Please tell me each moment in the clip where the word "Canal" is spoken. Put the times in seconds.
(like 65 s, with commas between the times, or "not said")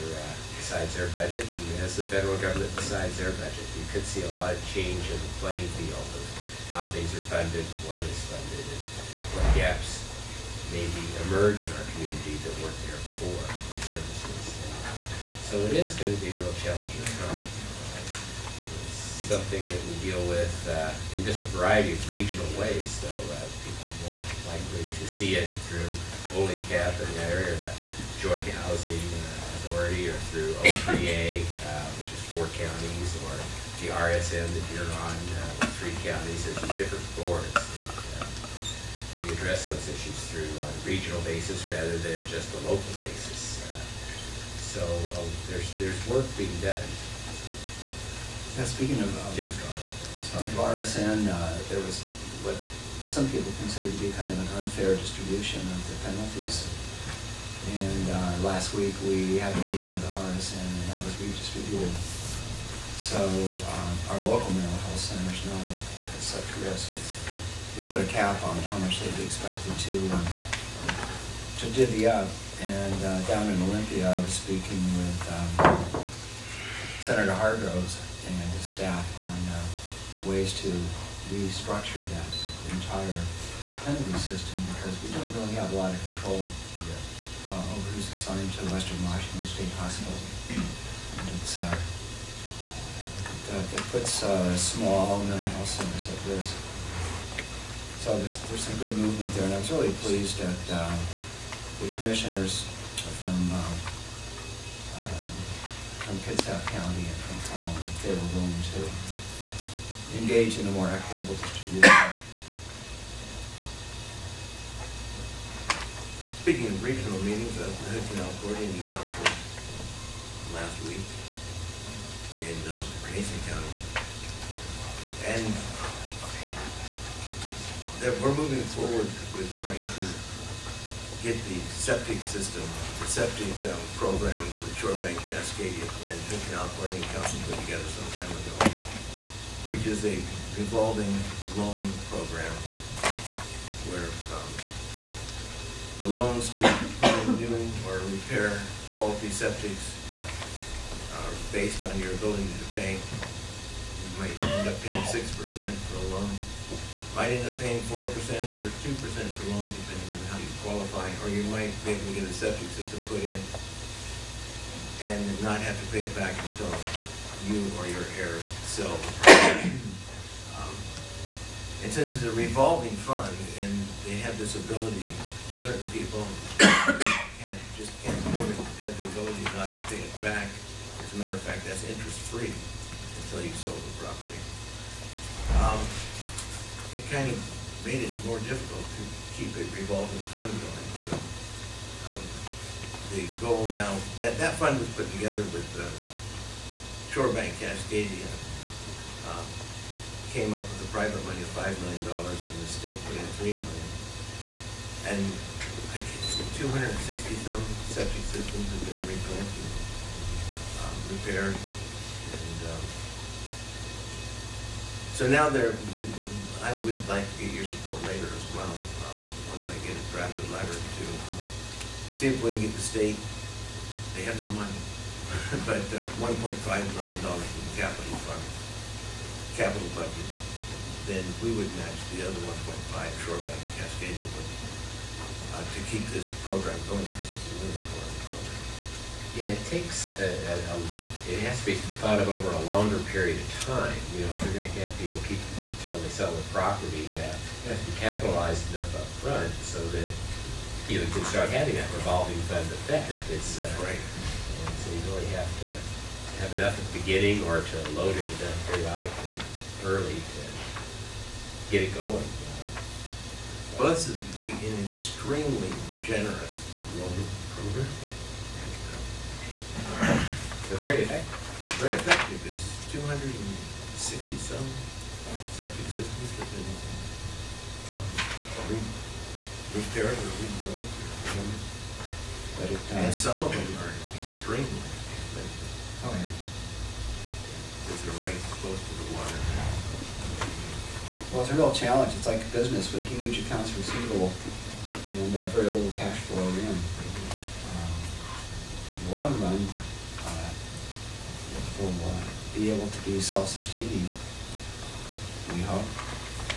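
118 s, 136 s.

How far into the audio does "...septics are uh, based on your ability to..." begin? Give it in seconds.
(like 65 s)
149 s.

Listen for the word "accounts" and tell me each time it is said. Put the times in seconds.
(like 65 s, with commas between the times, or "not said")
293 s.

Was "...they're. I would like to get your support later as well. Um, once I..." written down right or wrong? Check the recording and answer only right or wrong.
right.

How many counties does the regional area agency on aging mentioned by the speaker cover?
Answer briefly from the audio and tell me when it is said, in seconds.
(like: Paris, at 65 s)
4, at 32 s.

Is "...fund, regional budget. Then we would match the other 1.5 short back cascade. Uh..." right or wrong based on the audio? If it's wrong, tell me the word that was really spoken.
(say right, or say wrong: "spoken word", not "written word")
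wrong: "capital", not "regional".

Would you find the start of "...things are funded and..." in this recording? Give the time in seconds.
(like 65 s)
6 s.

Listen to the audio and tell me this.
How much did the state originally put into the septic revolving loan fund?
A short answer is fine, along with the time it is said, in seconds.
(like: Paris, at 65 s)
$3 million, at 203 s.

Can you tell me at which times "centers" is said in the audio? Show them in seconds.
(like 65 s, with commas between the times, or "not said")
64 s, 95 s.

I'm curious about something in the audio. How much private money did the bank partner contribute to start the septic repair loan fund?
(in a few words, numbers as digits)
$5 million.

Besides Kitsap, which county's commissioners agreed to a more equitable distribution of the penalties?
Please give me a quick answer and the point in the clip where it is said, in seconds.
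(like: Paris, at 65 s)
Clallam, at 107 s.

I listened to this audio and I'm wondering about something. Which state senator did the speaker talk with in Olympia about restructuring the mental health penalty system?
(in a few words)
Senator Hargroves.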